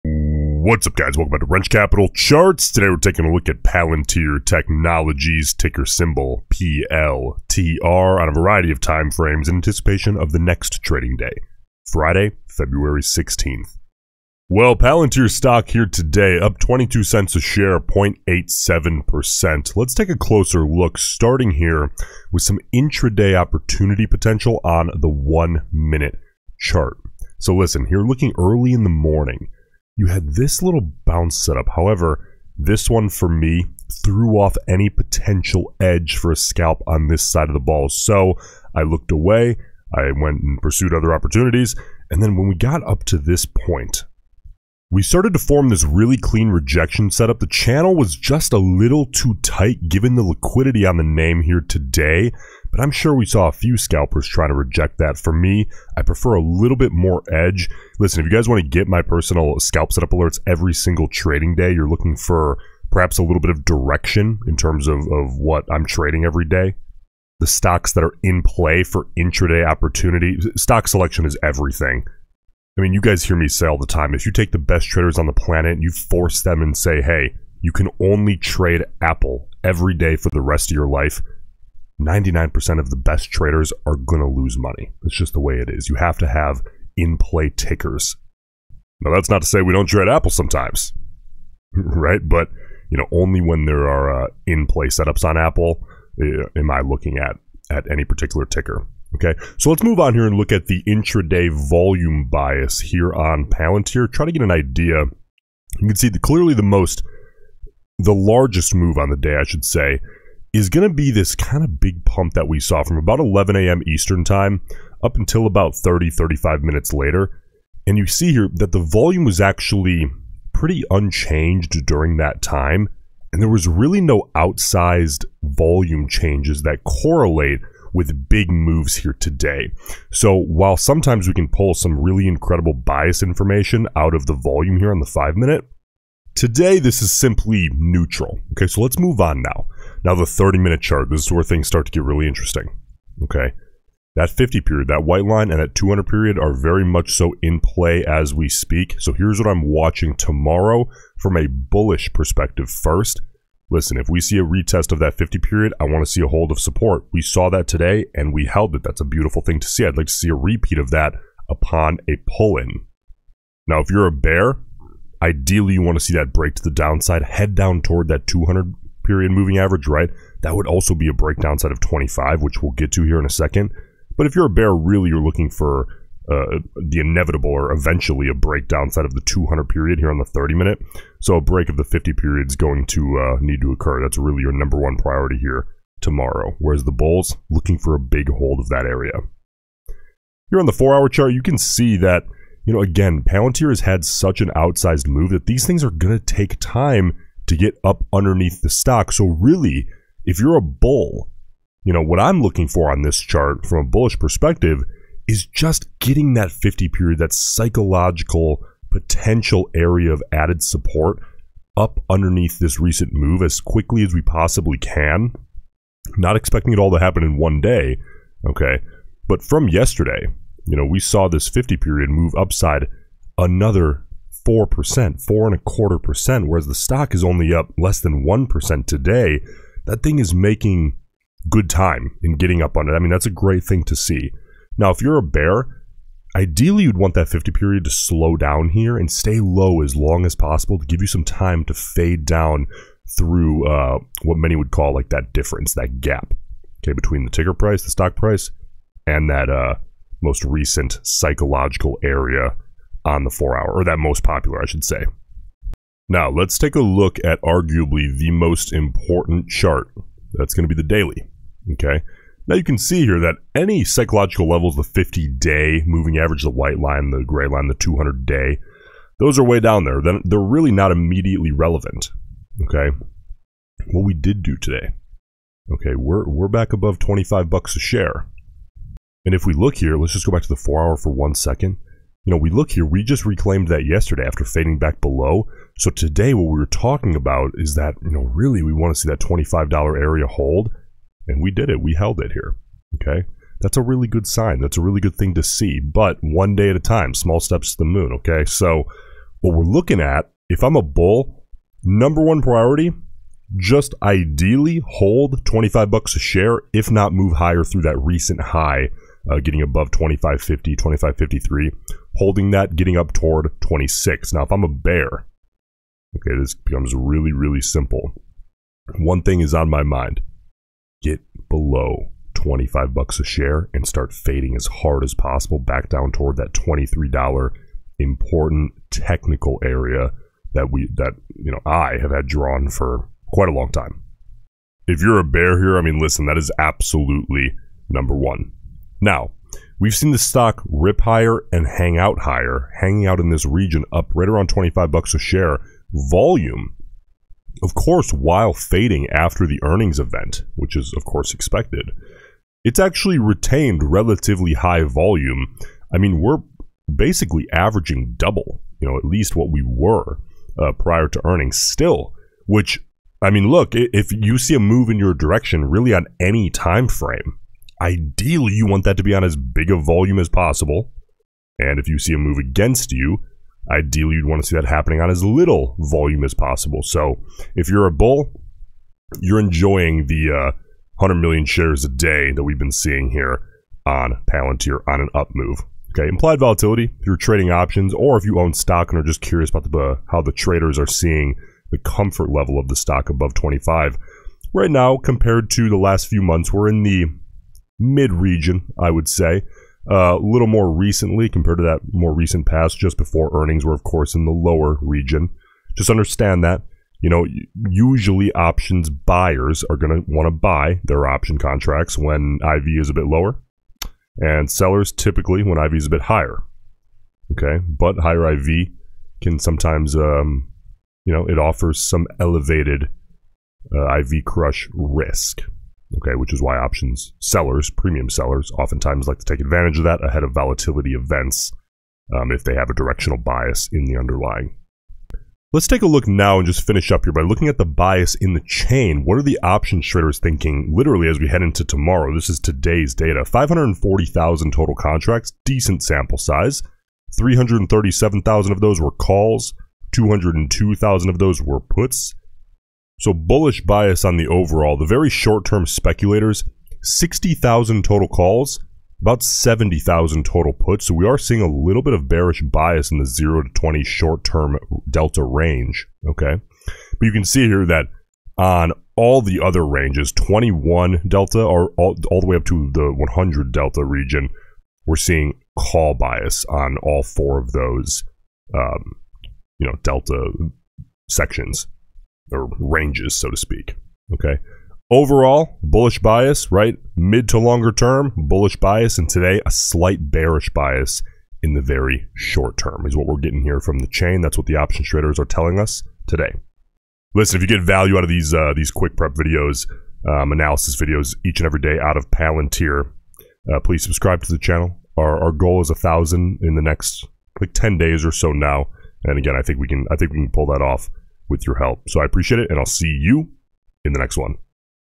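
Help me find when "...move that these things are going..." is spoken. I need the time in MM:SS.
03:15.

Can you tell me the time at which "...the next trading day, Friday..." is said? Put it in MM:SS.
00:10.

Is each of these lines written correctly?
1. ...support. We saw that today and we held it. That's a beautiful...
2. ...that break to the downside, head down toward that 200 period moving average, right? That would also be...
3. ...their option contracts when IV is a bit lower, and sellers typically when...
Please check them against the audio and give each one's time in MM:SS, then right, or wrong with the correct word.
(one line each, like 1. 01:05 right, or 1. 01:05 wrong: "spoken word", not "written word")
1. 02:36 right
2. 02:46 right
3. 06:50 right.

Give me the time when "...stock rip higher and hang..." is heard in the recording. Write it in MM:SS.
05:40.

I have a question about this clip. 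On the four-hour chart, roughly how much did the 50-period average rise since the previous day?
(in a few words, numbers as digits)
four and a quarter percent.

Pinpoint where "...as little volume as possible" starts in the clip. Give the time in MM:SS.
06:15.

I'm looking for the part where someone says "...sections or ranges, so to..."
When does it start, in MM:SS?
08:01.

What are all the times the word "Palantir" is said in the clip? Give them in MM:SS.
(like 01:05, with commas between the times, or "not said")
00:03, 00:14, 01:43, 03:13, 06:24, 08:22.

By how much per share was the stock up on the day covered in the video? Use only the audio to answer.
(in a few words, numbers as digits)
22 cents.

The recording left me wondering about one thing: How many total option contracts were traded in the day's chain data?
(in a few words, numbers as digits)
540,000.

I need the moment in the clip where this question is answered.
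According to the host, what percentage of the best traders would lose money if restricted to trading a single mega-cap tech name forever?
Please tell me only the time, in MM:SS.
01:22.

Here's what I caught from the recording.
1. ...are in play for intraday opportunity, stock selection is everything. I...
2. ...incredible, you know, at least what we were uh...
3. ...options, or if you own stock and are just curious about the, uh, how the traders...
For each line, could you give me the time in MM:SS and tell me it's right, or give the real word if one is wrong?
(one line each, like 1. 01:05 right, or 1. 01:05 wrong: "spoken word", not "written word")
1. 01:08 right
2. 05:58 wrong: "double", not "incredible"
3. 06:27 right.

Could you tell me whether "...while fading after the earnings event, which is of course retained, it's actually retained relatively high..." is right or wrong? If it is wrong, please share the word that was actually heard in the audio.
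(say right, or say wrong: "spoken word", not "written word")
wrong: "expected", not "retained".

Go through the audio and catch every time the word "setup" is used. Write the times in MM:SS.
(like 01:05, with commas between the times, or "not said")
00:31, 00:47, 00:59, 01:34.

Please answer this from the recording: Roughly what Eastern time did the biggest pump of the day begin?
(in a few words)
11 a.m.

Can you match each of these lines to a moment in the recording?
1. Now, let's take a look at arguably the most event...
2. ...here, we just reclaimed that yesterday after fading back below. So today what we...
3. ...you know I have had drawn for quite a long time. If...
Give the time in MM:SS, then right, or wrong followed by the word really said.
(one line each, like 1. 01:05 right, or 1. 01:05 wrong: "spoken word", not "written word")
1. 04:16 wrong: "important", not "event"
2. 04:42 right
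3. 05:31 right.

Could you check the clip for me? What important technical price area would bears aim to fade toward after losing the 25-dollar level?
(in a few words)
$23.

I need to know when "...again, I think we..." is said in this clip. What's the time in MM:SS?
08:29.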